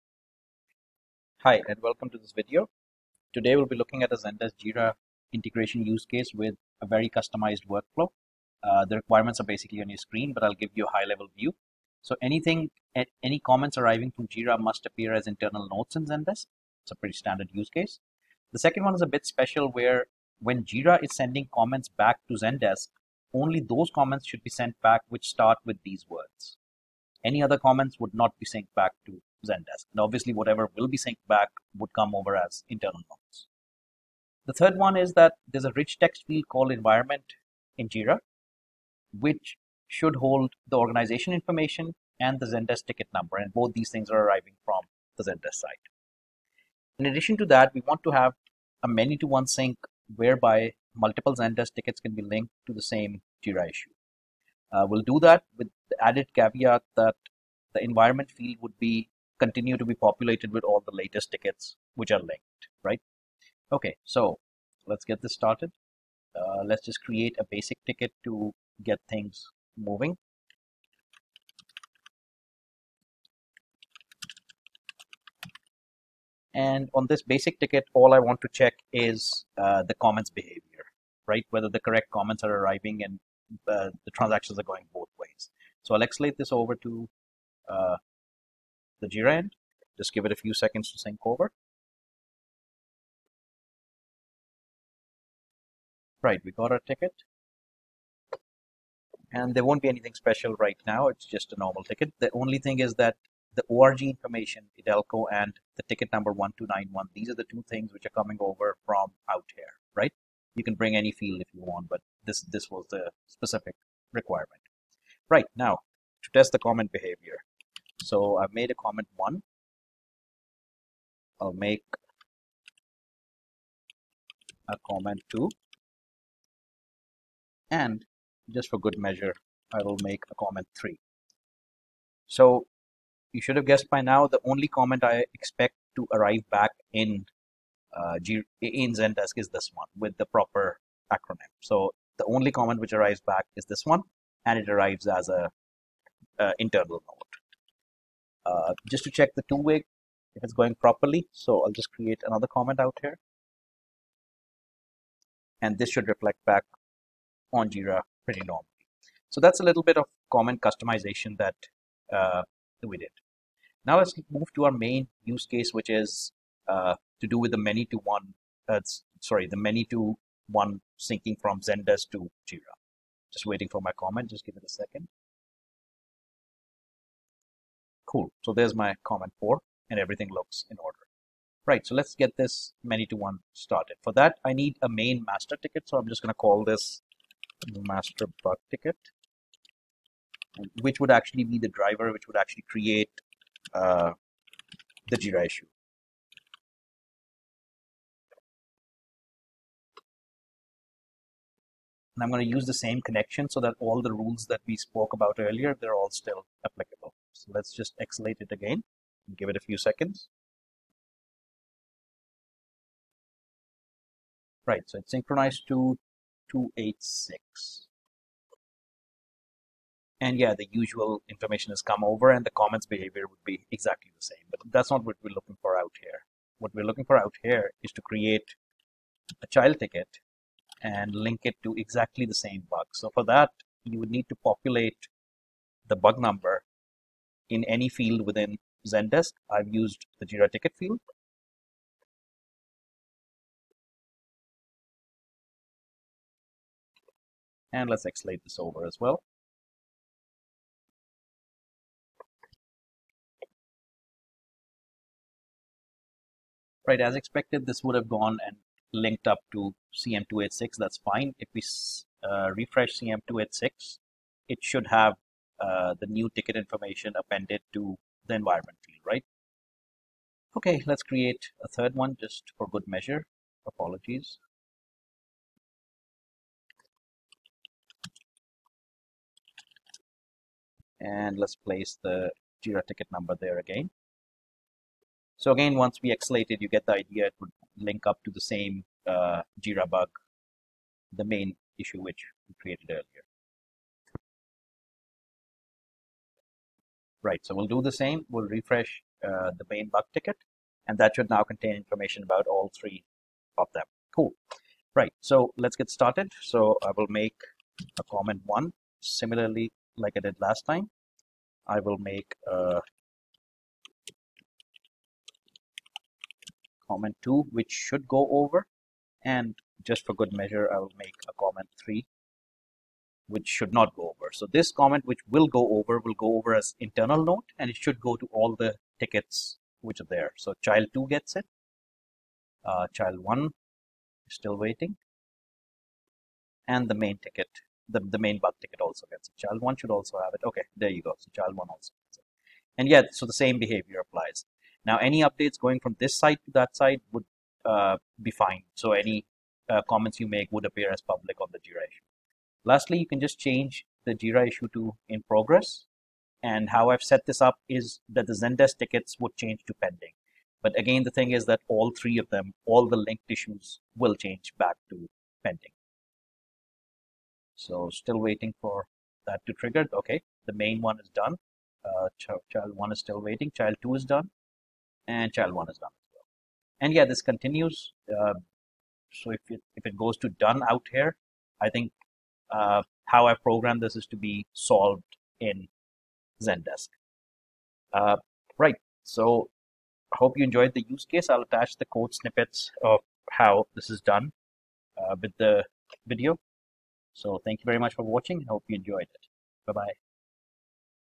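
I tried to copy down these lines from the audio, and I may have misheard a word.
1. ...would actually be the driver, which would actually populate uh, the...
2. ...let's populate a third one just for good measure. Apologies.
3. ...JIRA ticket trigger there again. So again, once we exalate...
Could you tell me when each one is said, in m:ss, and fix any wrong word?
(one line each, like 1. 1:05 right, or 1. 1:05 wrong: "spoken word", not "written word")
1. 3:10 wrong: "create", not "populate"
2. 4:30 wrong: "create", not "populate"
3. 4:42 wrong: "number", not "trigger".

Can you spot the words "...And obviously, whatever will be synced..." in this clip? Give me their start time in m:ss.
0:29.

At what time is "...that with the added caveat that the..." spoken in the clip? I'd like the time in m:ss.
0:55.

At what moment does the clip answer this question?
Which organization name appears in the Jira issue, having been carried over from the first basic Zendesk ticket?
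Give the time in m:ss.
1:44.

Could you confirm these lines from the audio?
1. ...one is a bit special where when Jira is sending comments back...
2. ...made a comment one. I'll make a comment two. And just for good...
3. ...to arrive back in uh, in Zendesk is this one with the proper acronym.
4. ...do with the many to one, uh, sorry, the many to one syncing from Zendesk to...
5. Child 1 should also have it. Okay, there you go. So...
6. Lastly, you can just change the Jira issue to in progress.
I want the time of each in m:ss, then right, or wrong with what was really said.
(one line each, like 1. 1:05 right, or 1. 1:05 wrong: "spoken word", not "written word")
1. 0:18 right
2. 1:58 right
3. 2:15 right
4. 2:47 right
5. 5:39 right
6. 5:52 right.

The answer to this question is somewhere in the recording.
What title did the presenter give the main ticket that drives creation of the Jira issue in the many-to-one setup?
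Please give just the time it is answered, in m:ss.
3:07.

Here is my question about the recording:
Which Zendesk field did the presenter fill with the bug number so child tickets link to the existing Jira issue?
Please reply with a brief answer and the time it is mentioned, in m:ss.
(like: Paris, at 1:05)
Jira ticket field, at 4:00.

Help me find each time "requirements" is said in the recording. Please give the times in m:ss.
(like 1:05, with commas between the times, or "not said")
0:08, 1:54.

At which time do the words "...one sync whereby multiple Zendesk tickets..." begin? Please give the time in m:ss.
0:49.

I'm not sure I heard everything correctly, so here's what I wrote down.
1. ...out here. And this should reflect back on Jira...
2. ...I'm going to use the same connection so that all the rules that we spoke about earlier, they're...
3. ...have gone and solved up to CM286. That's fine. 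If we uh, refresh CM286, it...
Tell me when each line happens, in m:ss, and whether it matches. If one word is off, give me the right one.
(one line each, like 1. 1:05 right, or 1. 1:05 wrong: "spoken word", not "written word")
1. 2:32 right
2. 3:22 right
3. 4:17 wrong: "linked", not "solved".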